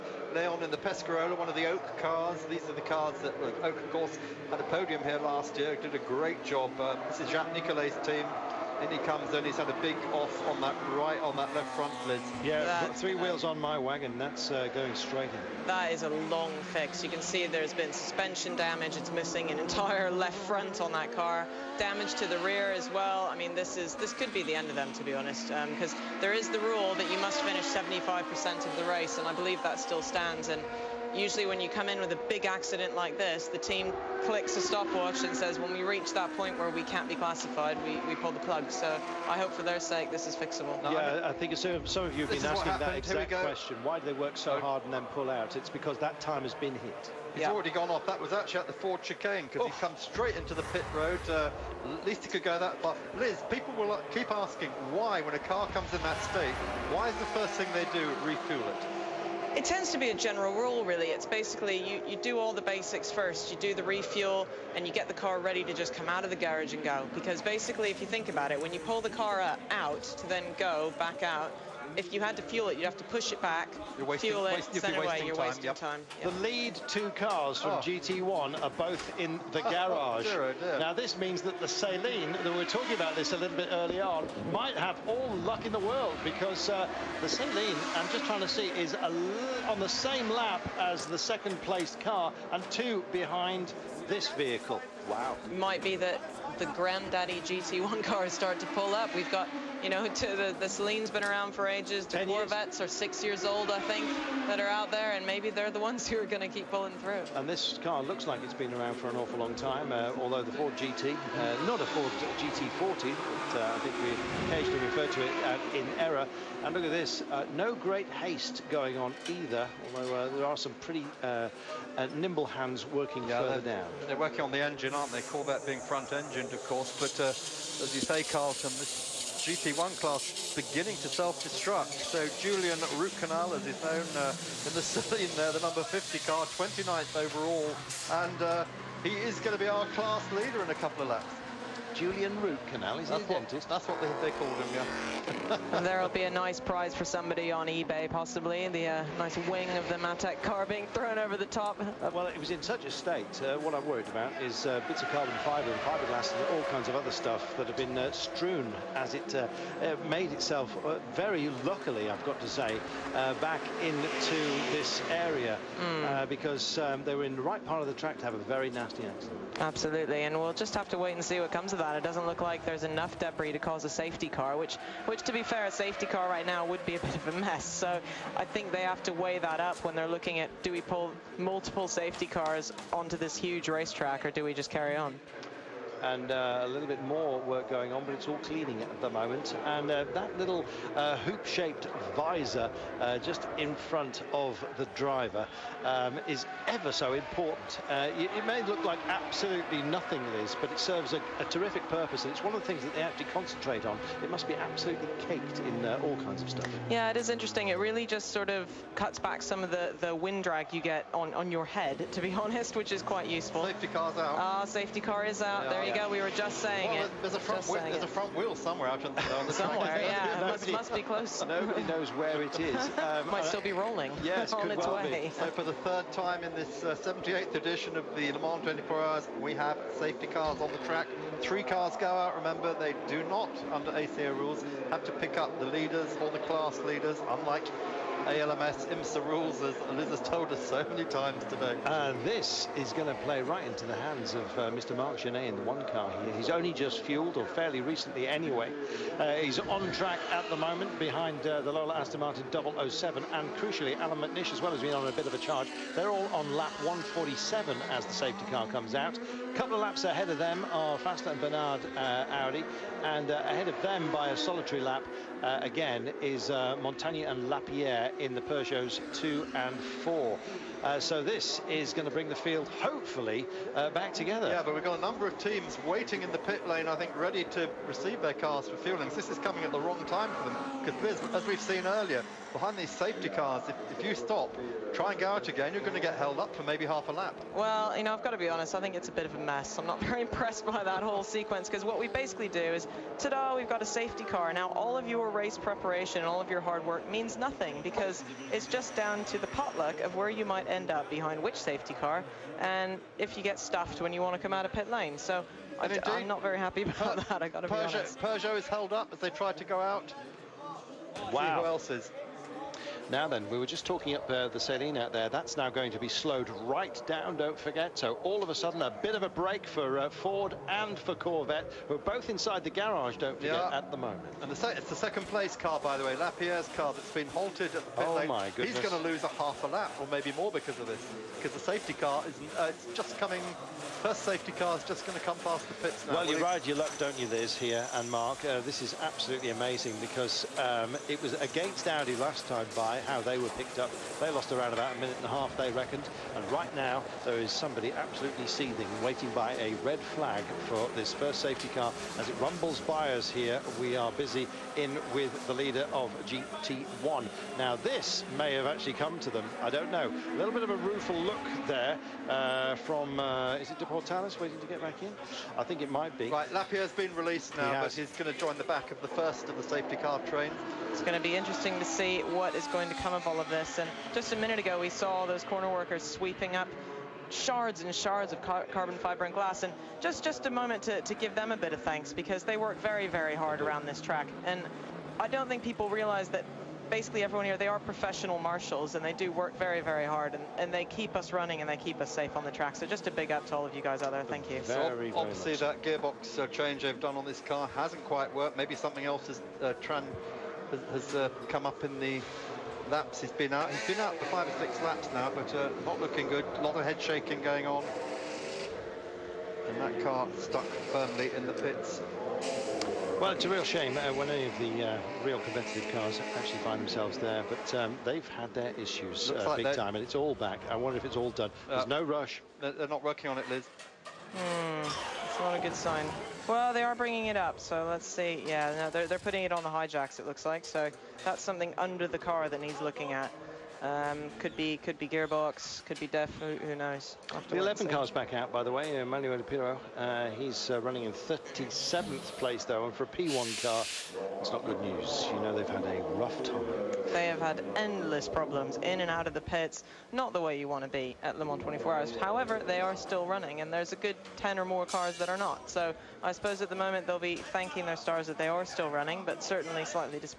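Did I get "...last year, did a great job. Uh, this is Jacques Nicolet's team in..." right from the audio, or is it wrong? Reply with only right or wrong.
right.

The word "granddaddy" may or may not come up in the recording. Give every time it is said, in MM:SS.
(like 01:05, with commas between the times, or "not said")
01:36.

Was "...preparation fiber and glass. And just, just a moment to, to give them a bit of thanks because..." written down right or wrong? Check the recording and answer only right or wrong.
wrong.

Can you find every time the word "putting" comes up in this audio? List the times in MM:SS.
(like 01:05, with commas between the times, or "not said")
07:09.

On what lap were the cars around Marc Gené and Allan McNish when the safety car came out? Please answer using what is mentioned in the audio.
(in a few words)
147.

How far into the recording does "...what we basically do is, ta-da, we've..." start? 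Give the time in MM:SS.
04:51.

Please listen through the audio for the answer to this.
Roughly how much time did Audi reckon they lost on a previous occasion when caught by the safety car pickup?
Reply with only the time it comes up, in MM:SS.
05:44.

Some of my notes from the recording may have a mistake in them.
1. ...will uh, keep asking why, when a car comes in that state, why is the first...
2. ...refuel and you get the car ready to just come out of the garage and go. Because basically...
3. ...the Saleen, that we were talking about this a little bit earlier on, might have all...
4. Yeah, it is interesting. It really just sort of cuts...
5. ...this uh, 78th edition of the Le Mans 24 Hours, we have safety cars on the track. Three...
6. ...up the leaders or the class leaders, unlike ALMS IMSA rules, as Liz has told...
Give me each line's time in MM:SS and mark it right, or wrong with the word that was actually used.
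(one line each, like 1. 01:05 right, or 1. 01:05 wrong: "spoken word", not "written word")
1. 00:53 right
2. 01:03 right
3. 01:21 right
4. 03:26 right
5. 03:46 right
6. 03:55 right.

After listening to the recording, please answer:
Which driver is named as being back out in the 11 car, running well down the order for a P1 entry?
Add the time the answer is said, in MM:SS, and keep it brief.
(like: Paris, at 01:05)
Emanuele Pirro, at 07:19.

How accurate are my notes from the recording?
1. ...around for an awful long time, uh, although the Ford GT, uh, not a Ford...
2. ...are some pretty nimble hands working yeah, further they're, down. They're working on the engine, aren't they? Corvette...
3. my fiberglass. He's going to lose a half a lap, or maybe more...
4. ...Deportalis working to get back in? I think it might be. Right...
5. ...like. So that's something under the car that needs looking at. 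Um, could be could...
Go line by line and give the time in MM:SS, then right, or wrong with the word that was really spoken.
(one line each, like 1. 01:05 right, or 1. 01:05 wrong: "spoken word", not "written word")
1. 01:48 right
2. 02:00 right
3. 05:28 wrong: "goodness", not "fiberglass"
4. 06:03 wrong: "waiting", not "working"
5. 07:10 right.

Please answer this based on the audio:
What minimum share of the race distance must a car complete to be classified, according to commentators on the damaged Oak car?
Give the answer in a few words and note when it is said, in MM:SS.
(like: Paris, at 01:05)
75%, at 00:27.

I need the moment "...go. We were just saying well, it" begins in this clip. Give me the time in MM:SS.
03:35.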